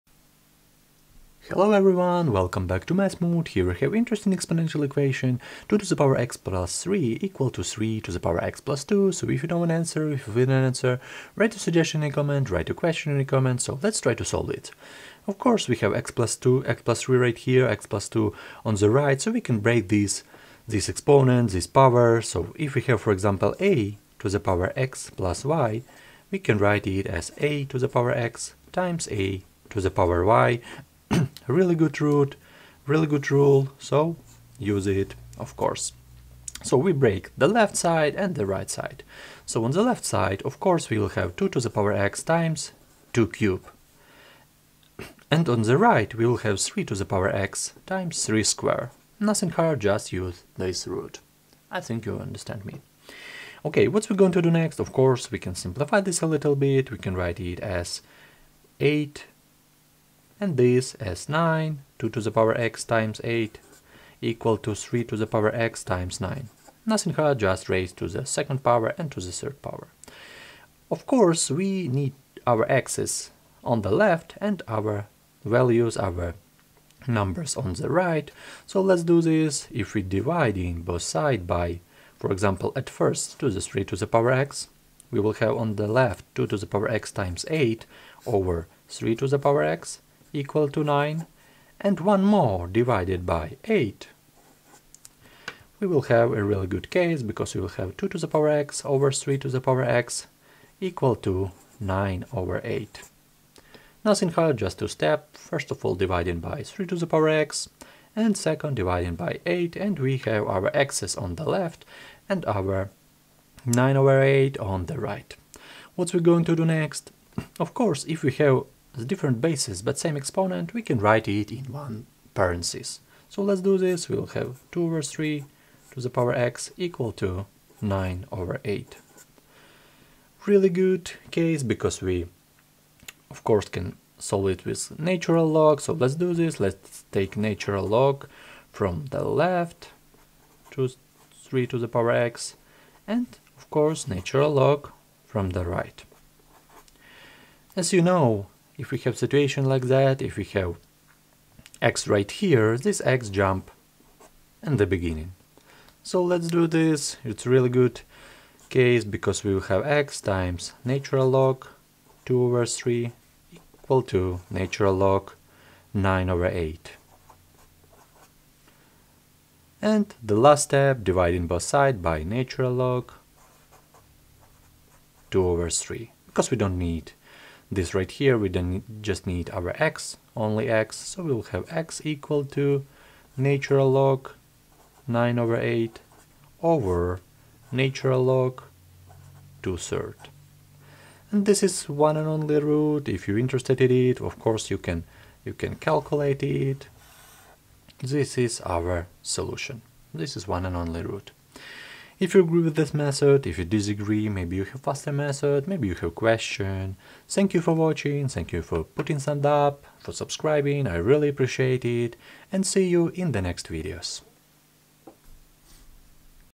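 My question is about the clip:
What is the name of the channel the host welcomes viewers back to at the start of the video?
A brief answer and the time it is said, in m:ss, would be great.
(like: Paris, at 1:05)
Math Mood, at 0:02.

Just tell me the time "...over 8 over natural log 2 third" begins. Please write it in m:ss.
3:05.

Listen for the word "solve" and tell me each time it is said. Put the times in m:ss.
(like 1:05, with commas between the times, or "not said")
0:14, 2:14.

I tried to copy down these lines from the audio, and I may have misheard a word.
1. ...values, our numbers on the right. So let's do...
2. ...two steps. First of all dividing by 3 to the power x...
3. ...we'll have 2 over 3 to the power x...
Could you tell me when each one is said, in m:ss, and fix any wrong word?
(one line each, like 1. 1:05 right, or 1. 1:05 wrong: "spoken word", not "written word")
1. 1:15 right
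2. 1:44 right
3. 2:04 right.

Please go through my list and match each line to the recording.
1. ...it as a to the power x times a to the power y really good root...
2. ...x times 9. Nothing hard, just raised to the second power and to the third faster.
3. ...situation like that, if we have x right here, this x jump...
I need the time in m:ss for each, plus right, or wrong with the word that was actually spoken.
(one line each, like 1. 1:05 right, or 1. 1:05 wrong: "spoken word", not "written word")
1. 0:26 right
2. 1:05 wrong: "power", not "faster"
3. 2:29 right.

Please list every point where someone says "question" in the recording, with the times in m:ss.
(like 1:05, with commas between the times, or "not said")
0:12, 3:26.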